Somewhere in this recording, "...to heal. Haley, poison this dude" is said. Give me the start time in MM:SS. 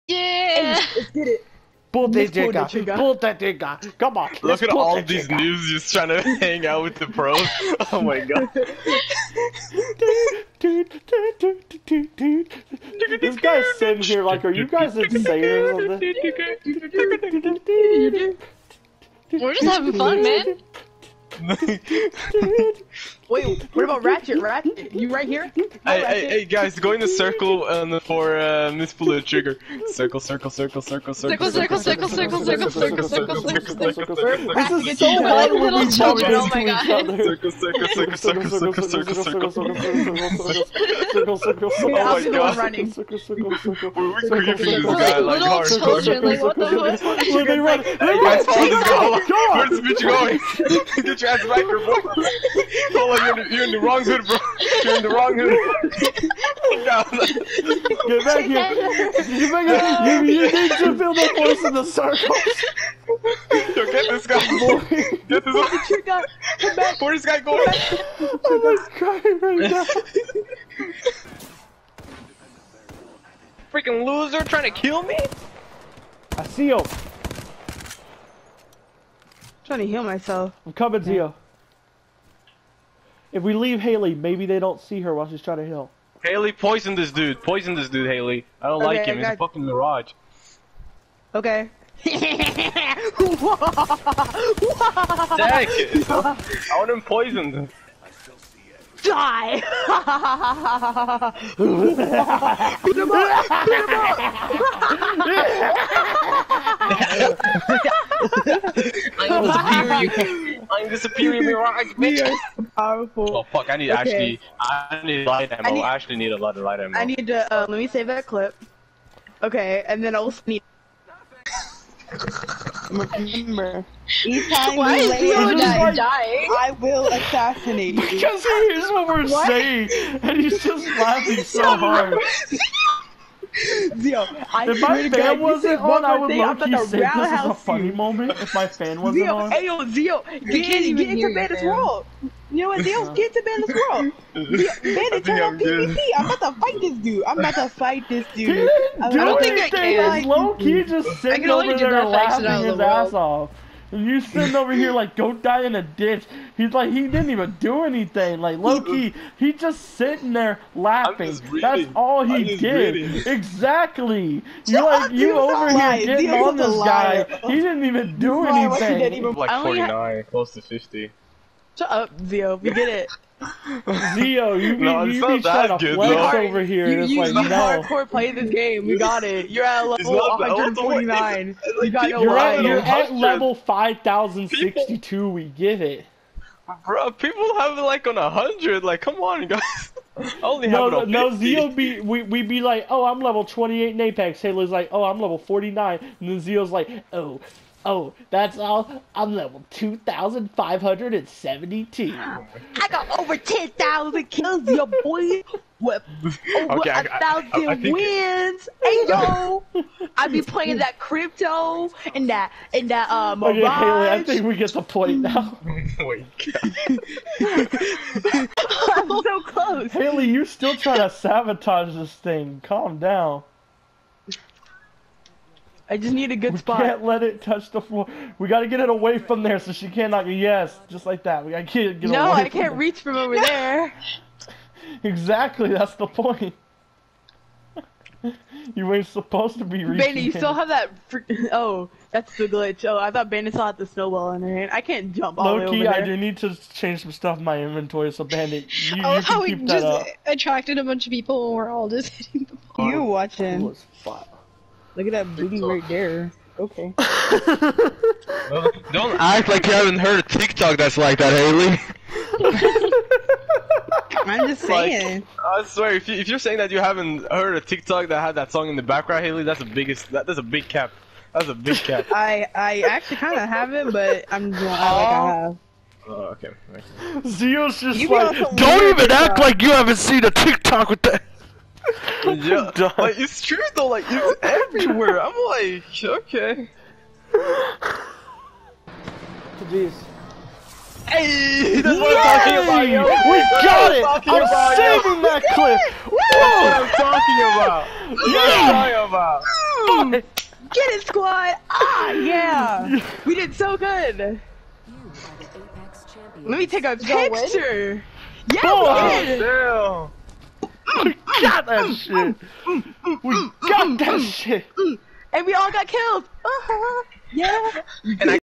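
01:25.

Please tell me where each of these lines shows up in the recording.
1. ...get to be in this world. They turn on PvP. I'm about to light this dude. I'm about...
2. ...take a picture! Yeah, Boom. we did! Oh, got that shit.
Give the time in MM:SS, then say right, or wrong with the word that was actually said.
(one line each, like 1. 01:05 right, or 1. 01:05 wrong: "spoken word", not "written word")
1. 02:23 wrong: "fight", not "light"
2. 05:06 right.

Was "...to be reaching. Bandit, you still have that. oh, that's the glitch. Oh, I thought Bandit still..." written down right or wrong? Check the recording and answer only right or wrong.
right.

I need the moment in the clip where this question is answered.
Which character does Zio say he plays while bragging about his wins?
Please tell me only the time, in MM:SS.
03:30.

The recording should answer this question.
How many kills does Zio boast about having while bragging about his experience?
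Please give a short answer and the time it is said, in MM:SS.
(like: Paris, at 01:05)
Over 10,000, at 03:22.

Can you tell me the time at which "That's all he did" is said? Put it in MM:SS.
02:41.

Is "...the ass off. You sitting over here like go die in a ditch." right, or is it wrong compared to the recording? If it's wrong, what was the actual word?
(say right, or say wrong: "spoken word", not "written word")
right.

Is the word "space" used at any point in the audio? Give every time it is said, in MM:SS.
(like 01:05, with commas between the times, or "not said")
not said.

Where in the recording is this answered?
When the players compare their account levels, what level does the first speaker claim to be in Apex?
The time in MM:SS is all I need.
03:13.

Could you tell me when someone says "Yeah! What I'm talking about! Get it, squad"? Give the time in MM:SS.
04:58.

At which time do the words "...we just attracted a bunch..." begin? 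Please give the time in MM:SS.
04:09.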